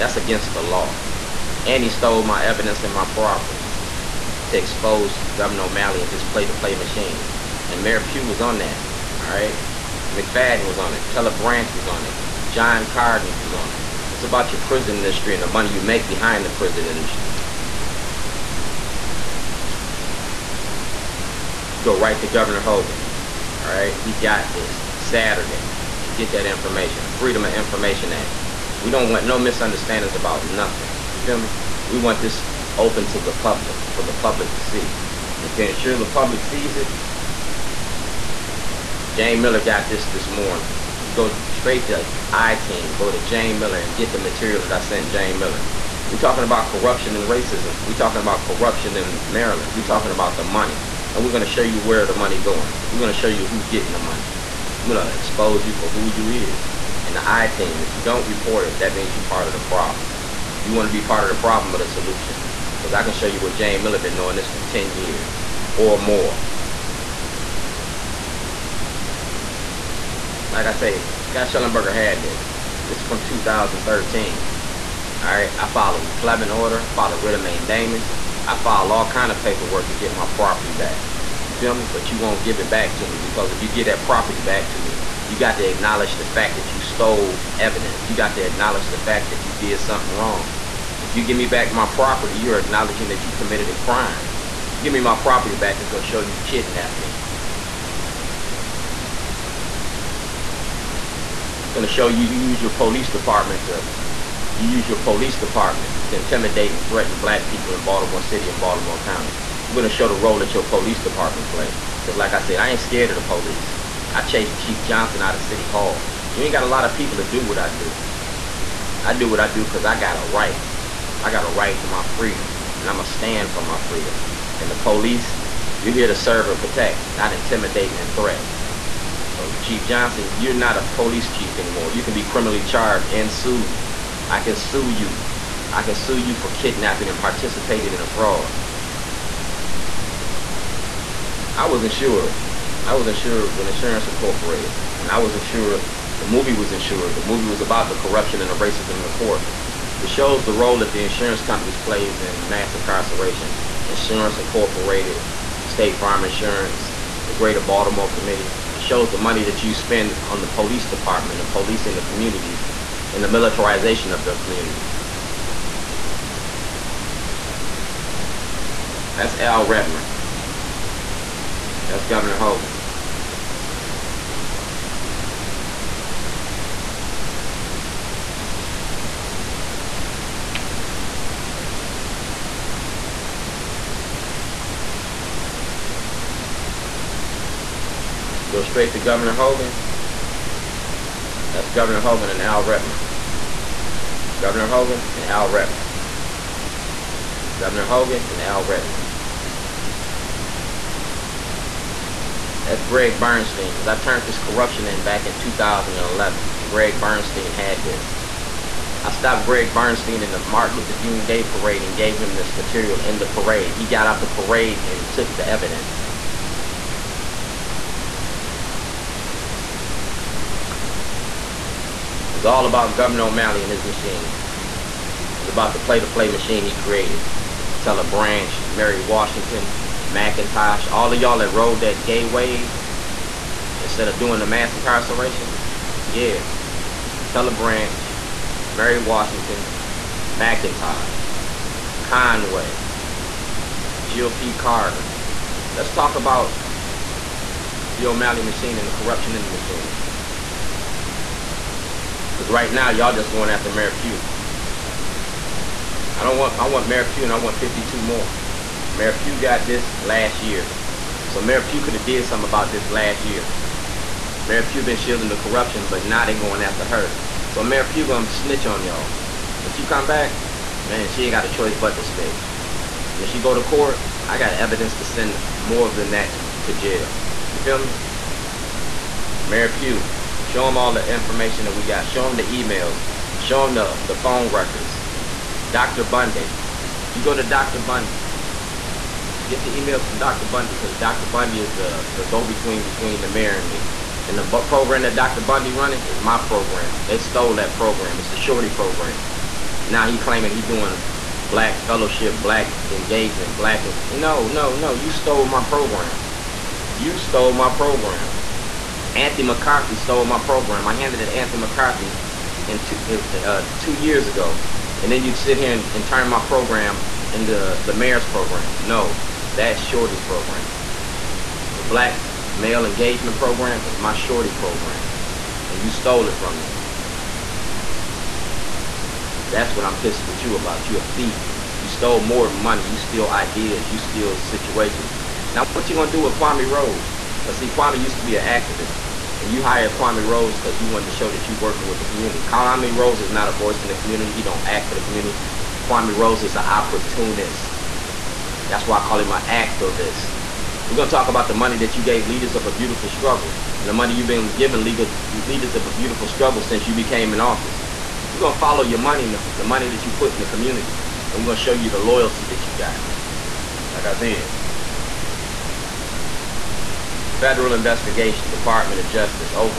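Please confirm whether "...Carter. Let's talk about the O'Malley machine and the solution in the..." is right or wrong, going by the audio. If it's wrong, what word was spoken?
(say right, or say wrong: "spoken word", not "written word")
wrong: "corruption", not "solution".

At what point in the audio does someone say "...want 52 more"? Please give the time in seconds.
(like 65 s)
257 s.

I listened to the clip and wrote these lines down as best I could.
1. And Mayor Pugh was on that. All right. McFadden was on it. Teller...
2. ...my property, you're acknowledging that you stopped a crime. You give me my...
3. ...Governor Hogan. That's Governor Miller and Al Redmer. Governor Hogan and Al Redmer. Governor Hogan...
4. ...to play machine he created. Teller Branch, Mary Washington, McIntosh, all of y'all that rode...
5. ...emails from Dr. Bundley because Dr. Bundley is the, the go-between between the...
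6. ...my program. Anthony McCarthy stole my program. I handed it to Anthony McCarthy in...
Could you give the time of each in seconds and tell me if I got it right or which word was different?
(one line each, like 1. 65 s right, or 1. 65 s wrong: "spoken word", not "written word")
1. 7 s right
2. 91 s wrong: "committed", not "stopped"
3. 188 s wrong: "Hogan", not "Miller"
4. 225 s right
5. 289 s right
6. 307 s right.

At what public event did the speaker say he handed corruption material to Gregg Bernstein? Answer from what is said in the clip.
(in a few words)
Martin Luther King Day parade.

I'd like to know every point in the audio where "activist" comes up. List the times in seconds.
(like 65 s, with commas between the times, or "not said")
338 s, 349 s.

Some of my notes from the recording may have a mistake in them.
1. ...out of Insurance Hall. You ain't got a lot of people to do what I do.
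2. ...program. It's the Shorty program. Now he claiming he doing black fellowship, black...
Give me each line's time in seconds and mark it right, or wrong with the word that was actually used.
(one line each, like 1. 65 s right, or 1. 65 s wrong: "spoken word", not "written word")
1. 115 s wrong: "City", not "Insurance"
2. 297 s right.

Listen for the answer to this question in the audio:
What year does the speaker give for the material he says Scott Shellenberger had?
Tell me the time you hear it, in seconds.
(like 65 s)
73 s.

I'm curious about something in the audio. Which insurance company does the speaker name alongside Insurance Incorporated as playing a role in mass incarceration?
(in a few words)
State Farm.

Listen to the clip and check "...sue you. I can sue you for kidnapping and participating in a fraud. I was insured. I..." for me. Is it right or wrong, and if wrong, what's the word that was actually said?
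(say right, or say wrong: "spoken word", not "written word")
right.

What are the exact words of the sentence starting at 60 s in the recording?
You want to be part of the problem or the solution.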